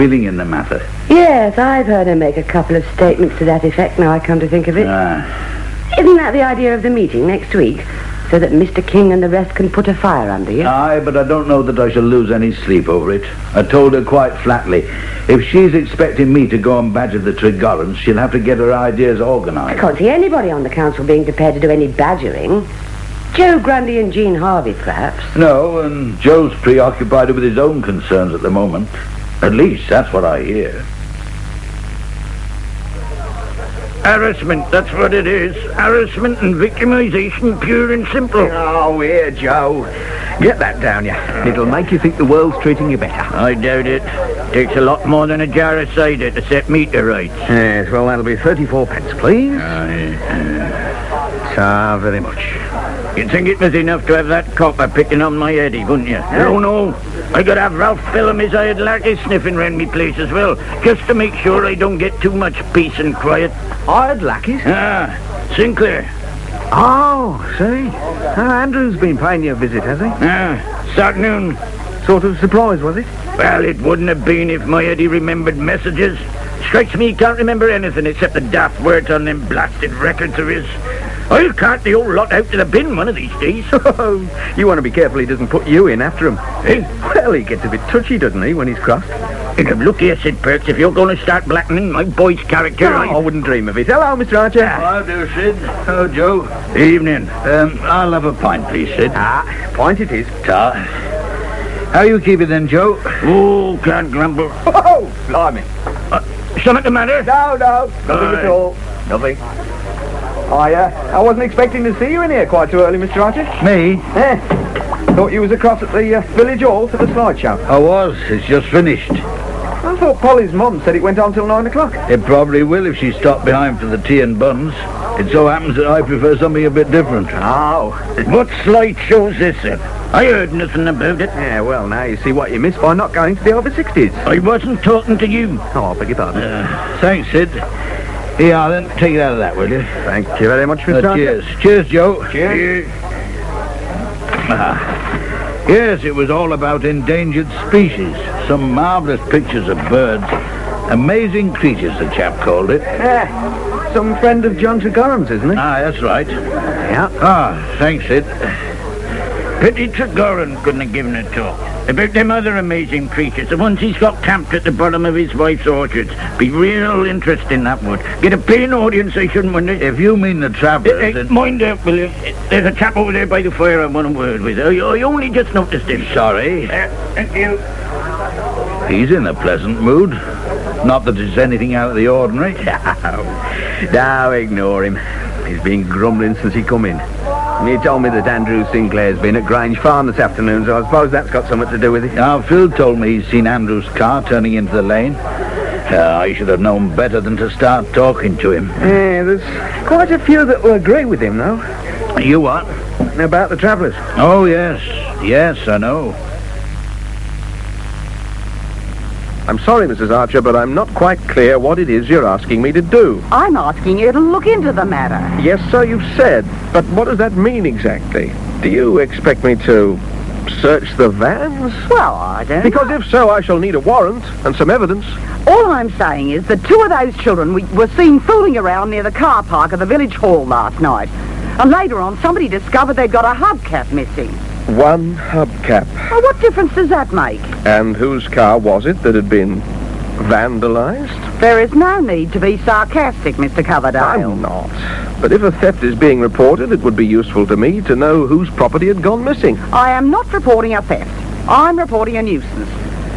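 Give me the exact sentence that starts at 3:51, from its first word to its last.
And later on, somebody discovered they'd got a hubcap missing.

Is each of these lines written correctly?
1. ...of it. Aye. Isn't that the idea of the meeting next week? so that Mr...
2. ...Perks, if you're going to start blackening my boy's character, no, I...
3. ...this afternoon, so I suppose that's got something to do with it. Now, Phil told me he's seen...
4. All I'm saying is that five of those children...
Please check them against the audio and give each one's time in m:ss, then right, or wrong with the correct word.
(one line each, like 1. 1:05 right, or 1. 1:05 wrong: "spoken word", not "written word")
1. 0:04 right
2. 1:30 right
3. 3:10 right
4. 3:45 wrong: "two", not "five".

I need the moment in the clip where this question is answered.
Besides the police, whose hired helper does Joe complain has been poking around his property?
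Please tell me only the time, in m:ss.
0:57.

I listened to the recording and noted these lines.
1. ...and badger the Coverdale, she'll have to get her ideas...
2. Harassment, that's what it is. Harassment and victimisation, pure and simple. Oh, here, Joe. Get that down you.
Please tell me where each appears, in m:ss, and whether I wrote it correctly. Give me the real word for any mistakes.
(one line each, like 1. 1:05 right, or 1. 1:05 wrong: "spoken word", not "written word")
1. 0:16 wrong: "Tregorrans", not "Coverdale"
2. 0:34 right.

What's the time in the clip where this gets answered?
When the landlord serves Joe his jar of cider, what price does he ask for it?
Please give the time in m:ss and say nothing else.
0:48.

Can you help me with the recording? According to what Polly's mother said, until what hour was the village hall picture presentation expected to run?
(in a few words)
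9 o'clock.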